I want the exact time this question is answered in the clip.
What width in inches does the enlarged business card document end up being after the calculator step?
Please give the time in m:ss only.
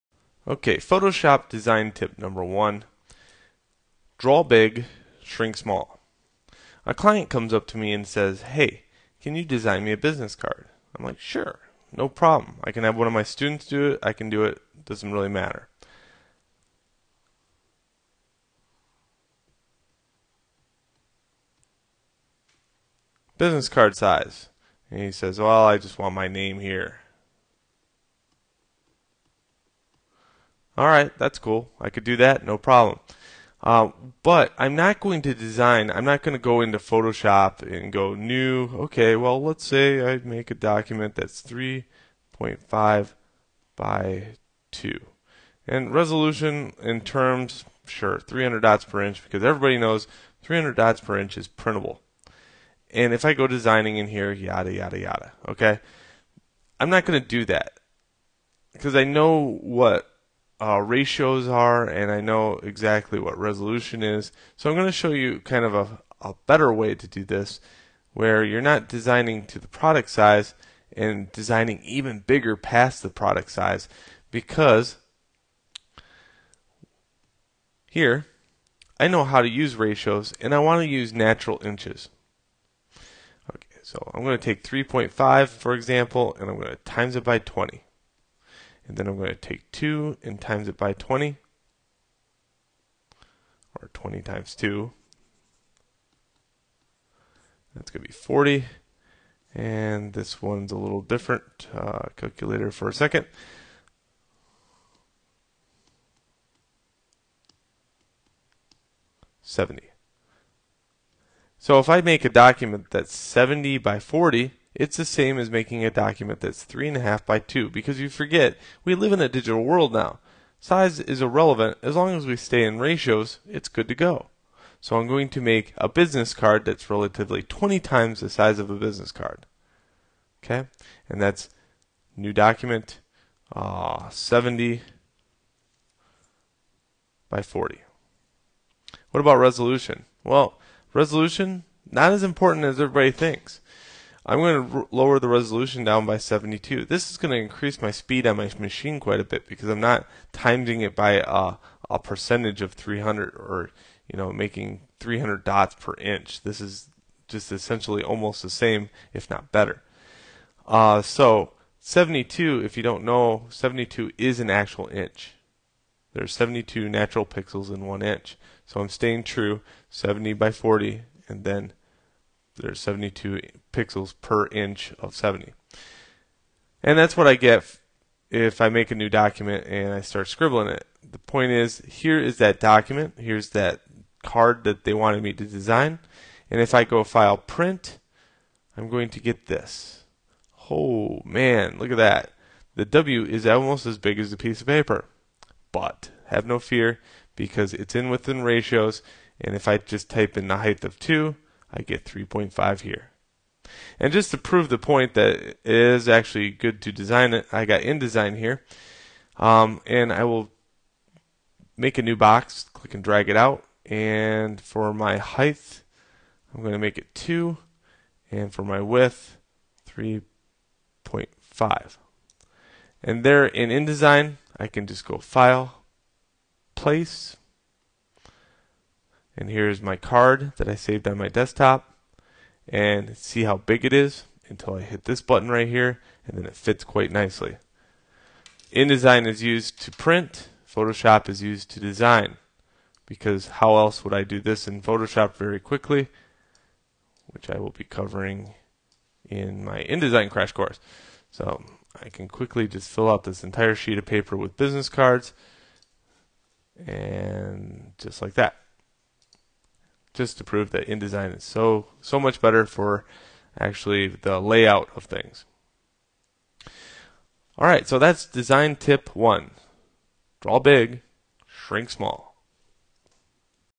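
1:49.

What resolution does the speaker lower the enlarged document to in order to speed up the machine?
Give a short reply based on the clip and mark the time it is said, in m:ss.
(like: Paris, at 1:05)
72, at 2:24.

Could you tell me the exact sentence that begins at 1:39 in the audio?
And this one's a little different.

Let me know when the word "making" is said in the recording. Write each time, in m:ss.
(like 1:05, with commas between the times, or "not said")
1:55, 2:34.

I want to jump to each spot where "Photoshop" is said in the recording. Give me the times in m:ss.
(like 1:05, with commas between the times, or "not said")
0:00, 0:36, 4:00, 4:04.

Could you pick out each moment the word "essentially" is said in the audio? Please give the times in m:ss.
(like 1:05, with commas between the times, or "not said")
2:37.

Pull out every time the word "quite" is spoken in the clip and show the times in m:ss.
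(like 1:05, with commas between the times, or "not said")
2:28, 3:56.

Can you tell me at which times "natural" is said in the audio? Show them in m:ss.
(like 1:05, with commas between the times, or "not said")
1:21, 2:46.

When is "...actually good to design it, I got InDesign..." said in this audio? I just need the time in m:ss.
3:26.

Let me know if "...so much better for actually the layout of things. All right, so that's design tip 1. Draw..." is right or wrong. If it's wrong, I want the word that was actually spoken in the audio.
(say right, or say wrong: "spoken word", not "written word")
right.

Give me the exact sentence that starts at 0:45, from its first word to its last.
And resolution in terms, sure, 300 dots per inch, because everybody knows 300 dots per inch is printable.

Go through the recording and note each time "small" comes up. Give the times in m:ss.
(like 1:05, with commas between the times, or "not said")
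0:05, 4:31.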